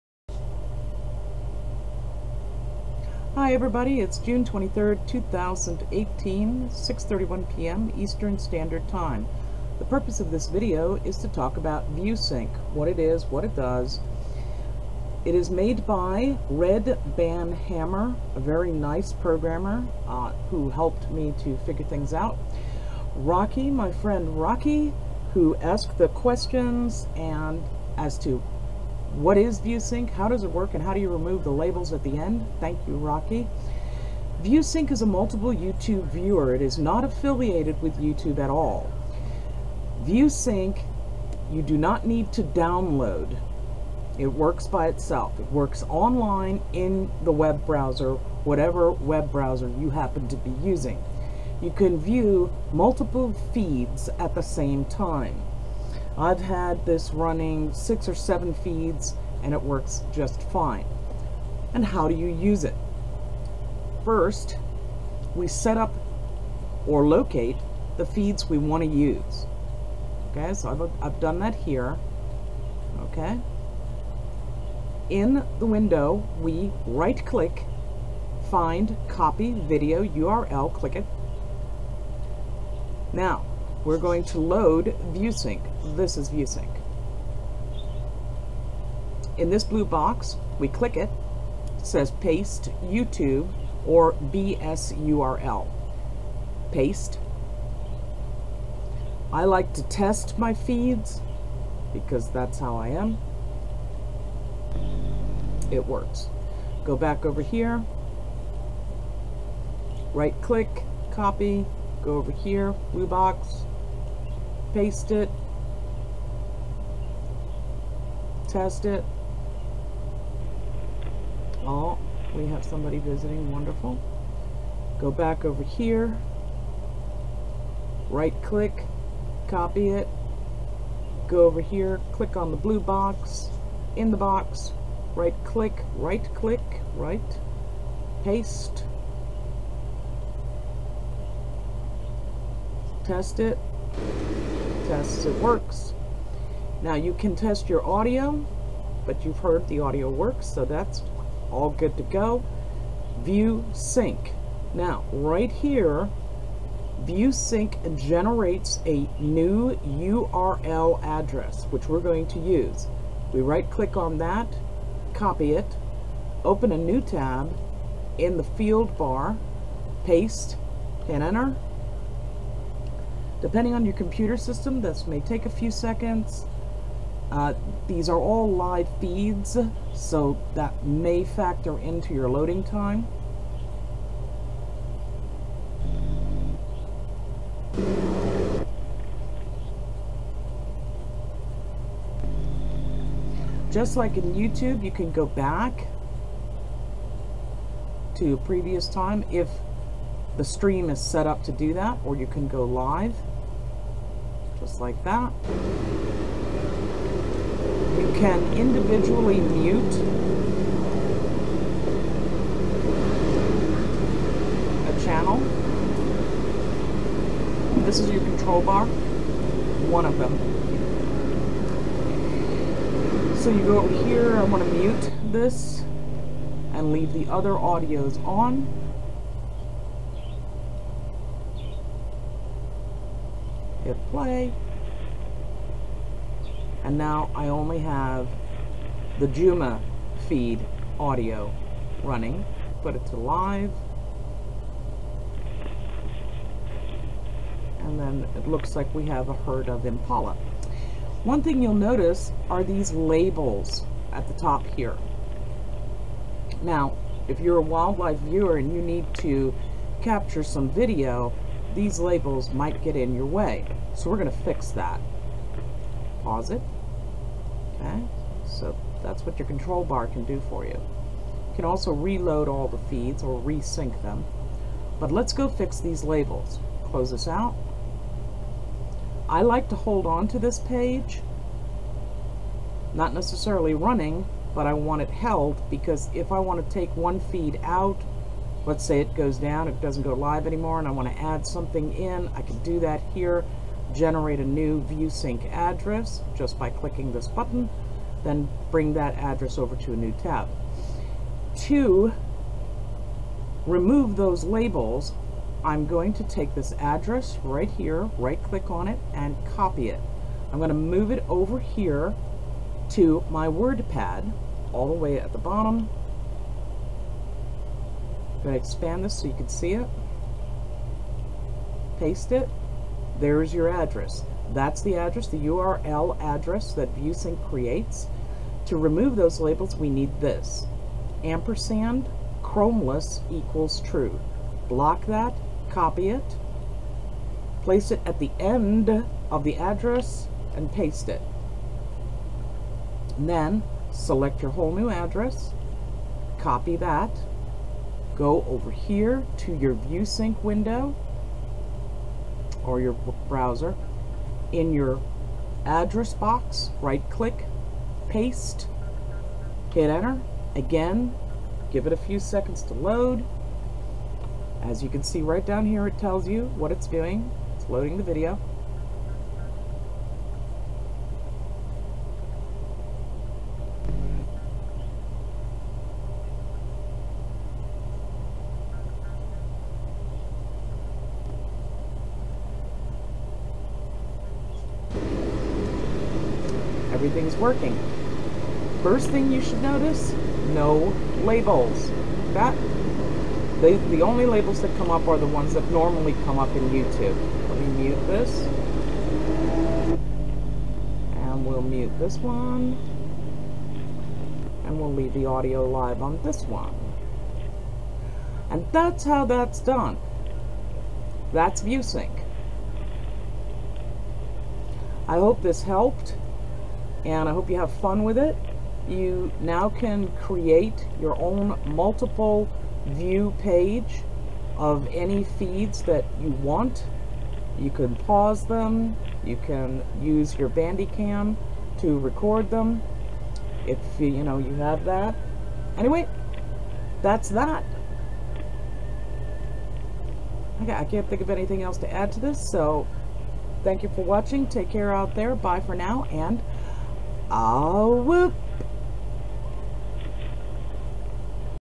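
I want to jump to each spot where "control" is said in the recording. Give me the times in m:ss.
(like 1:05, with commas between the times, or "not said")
3:38, 4:29.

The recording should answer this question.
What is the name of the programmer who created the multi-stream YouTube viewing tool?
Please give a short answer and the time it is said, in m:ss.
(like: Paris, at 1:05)
Red Ban Hammer, at 0:16.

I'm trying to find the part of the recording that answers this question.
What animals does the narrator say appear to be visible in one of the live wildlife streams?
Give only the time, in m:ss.
4:09.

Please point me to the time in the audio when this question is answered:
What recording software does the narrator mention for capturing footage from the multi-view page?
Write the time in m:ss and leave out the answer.
7:10.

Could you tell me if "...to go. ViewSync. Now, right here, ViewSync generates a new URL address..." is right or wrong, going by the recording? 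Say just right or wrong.
right.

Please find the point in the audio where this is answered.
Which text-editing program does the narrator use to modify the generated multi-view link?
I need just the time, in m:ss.
5:13.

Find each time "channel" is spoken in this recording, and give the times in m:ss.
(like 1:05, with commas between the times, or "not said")
3:35.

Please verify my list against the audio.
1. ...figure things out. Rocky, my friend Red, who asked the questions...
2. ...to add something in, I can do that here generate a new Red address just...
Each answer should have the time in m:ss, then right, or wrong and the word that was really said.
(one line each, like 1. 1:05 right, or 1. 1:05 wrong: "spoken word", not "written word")
1. 0:21 wrong: "Rocky", not "Red"
2. 4:51 wrong: "ViewSync", not "Red".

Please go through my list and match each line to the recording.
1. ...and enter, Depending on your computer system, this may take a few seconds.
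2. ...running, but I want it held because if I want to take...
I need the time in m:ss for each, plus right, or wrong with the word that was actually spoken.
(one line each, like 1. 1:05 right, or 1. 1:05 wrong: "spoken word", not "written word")
1. 2:51 right
2. 4:43 right.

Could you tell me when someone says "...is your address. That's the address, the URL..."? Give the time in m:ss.
5:23.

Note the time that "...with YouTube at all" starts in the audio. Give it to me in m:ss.
0:37.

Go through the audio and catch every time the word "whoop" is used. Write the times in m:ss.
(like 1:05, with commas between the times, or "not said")
7:28.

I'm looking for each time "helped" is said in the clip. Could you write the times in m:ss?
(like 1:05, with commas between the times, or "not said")
0:20, 6:55.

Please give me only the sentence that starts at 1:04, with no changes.
First, we set up or locate the feeds we want to use.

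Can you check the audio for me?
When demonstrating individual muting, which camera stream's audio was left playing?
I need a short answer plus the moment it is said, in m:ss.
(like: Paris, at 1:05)
Djuma, at 3:59.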